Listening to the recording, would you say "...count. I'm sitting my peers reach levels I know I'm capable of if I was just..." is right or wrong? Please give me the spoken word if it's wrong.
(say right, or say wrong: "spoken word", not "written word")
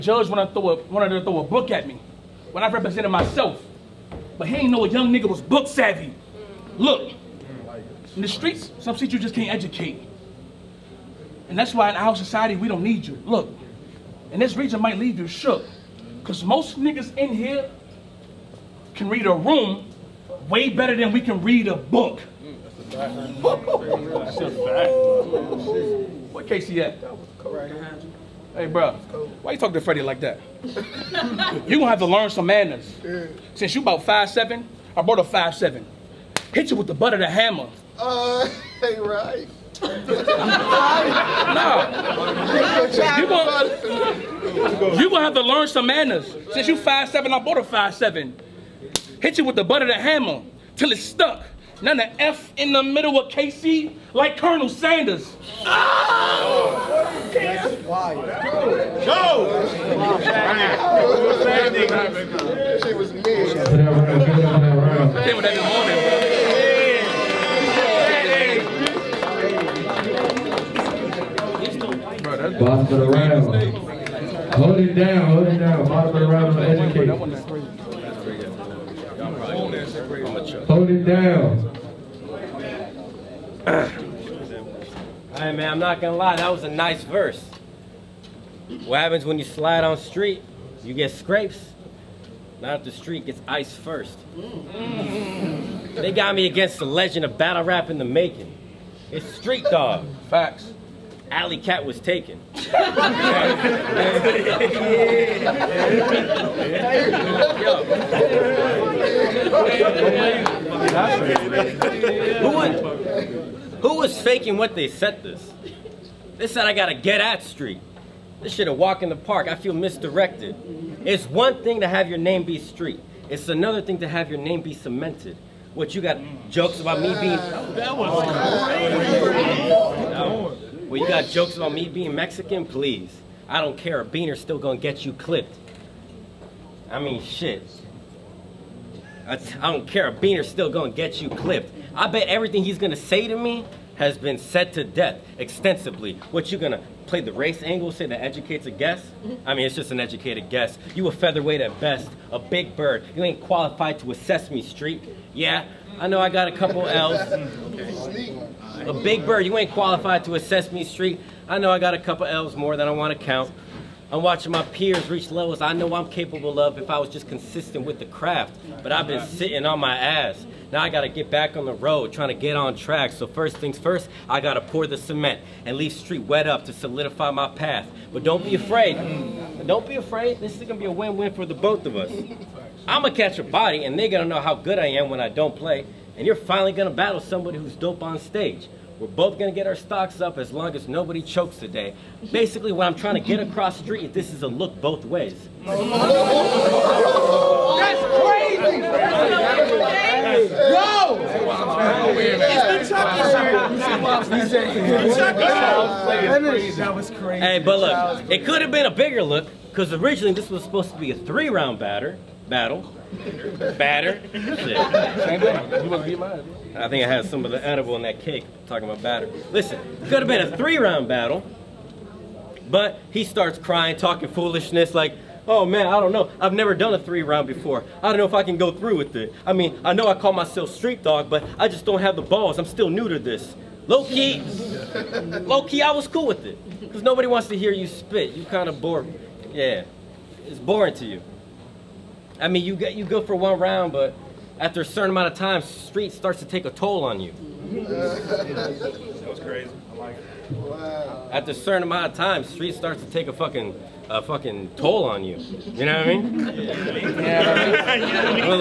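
wrong: "watching", not "sitting".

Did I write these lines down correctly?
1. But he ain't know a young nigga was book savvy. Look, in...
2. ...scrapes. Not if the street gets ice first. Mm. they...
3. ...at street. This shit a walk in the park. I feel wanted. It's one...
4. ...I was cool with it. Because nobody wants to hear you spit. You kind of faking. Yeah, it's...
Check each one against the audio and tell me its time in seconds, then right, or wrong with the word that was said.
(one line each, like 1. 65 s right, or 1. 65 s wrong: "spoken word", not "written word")
1. 4 s right
2. 91 s right
3. 117 s wrong: "misdirected", not "wanted"
4. 235 s wrong: "boring", not "faking".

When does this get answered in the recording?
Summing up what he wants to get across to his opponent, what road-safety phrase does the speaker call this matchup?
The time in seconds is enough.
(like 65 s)
194 s.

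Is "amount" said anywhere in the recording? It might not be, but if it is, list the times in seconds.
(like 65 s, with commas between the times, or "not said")
245 s, 251 s.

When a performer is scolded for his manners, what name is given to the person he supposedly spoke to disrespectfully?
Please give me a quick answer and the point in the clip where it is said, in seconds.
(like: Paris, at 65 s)
Freddie, at 29 s.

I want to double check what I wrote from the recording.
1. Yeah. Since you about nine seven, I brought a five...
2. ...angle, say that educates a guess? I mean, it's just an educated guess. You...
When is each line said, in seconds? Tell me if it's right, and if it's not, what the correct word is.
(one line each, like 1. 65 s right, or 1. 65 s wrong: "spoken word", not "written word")
1. 33 s wrong: "five", not "nine"
2. 147 s right.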